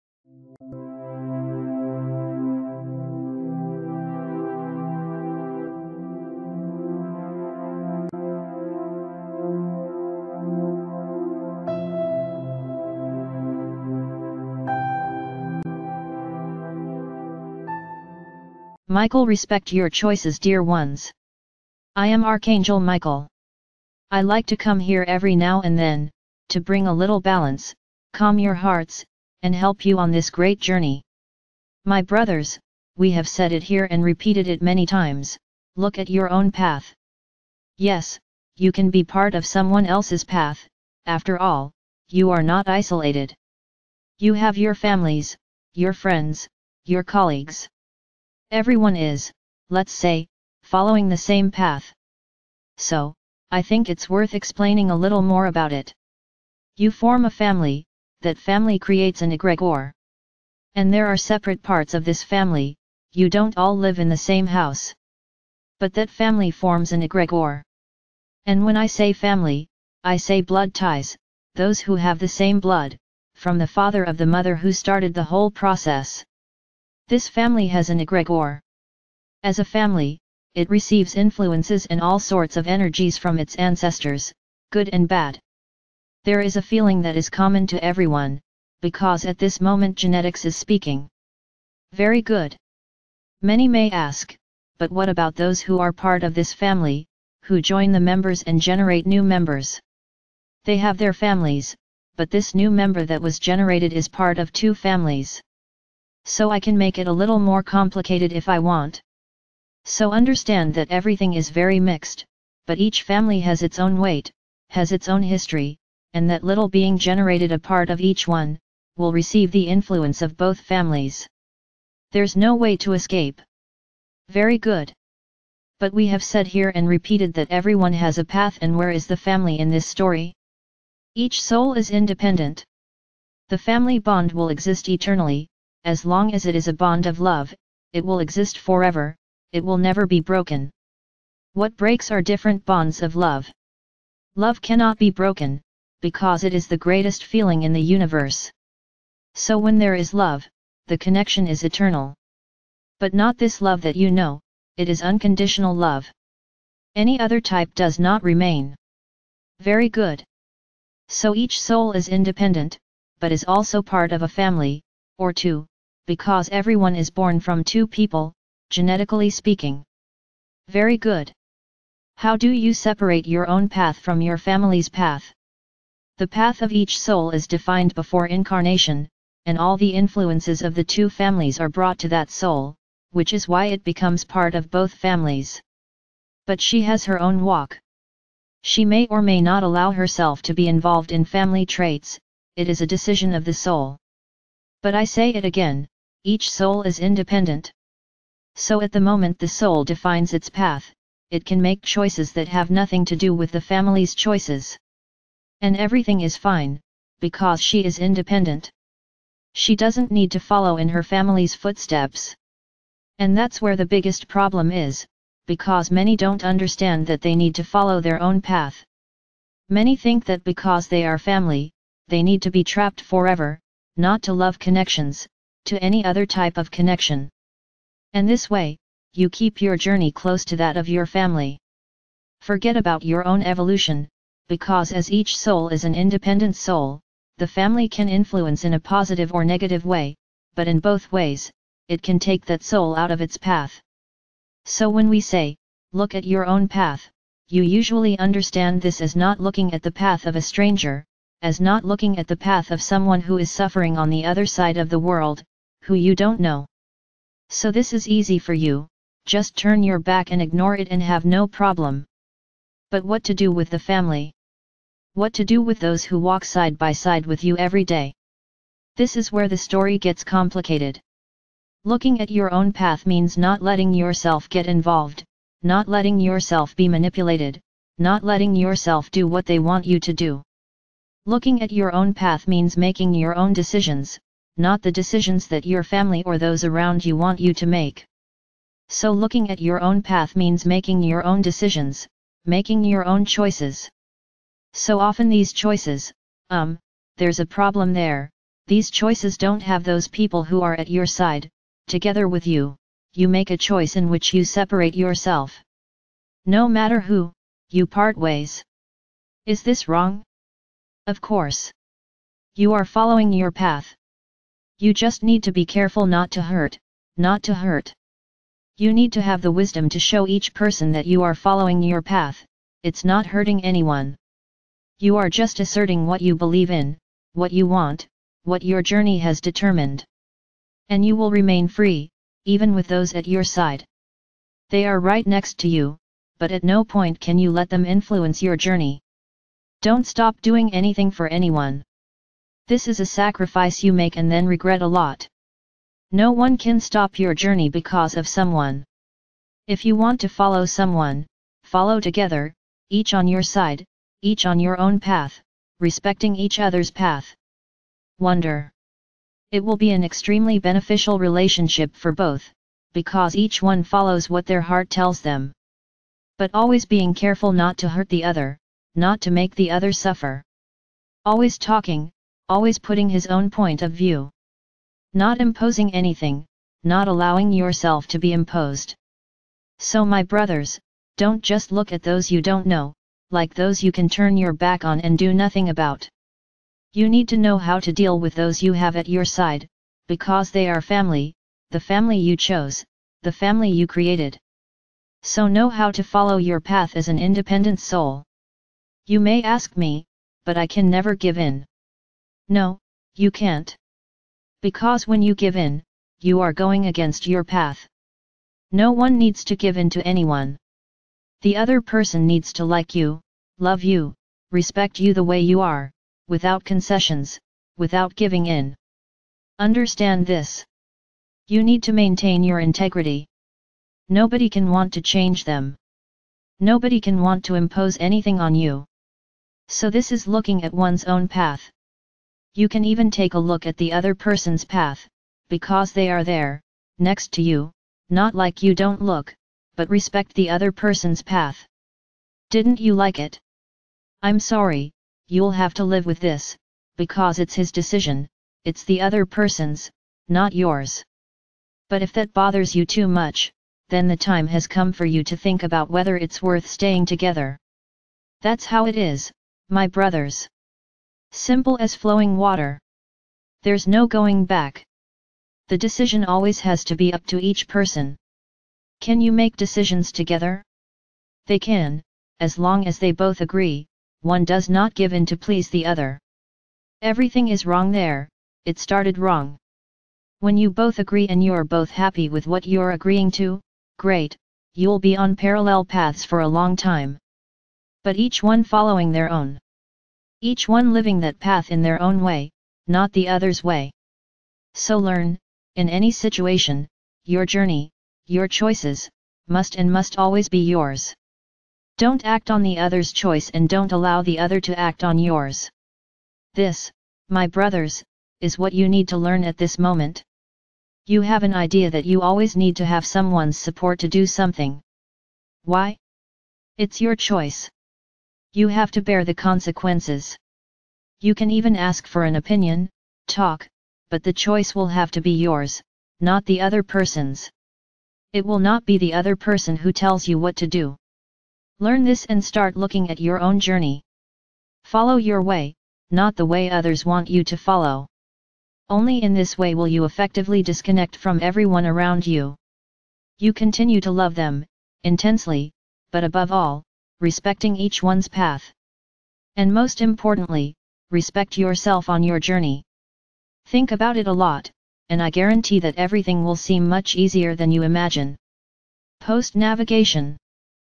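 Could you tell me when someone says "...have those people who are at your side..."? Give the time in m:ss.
4:59.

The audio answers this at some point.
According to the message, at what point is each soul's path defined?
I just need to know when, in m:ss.
2:57.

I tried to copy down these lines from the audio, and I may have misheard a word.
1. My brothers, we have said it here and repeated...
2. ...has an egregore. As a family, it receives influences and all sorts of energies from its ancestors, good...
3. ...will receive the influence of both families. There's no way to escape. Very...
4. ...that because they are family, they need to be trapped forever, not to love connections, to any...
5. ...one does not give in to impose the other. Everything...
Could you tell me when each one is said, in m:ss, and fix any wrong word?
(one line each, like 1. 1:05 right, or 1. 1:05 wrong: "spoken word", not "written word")
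1. 0:31 right
2. 1:17 right
3. 1:58 right
4. 3:40 right
5. 7:54 wrong: "please", not "impose".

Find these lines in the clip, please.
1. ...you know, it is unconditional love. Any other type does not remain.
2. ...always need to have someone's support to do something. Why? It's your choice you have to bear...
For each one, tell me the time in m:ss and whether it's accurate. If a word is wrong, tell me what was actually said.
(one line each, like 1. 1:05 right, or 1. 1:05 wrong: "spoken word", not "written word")
1. 2:33 right
2. 8:32 right.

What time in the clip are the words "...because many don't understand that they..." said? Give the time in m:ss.
3:35.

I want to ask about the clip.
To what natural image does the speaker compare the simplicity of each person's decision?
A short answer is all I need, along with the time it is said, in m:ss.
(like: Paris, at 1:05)
flowing water, at 7:41.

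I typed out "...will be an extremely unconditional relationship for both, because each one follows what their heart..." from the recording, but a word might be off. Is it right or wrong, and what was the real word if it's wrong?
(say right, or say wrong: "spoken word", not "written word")
wrong: "beneficial", not "unconditional".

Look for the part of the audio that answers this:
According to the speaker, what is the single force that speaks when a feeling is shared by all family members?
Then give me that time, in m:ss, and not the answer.
1:29.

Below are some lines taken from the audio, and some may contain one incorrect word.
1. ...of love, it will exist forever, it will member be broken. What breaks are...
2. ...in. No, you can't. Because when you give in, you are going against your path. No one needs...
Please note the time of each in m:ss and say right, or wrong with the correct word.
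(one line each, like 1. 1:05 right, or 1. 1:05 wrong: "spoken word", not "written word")
1. 2:17 wrong: "never", not "member"
2. 6:41 right.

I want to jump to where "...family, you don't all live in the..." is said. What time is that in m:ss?
1:02.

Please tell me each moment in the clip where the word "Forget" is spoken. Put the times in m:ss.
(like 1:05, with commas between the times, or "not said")
3:52.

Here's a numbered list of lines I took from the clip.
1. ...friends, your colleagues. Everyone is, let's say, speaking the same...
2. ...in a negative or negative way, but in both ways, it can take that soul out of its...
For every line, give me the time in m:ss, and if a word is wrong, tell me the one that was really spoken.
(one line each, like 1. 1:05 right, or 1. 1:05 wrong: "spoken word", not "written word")
1. 0:45 wrong: "following", not "speaking"
2. 3:58 wrong: "positive", not "negative".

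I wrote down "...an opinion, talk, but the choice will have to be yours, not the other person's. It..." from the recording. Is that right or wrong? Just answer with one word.
right.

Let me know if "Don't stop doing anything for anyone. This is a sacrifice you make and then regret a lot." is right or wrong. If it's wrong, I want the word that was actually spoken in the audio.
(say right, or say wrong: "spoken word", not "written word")
right.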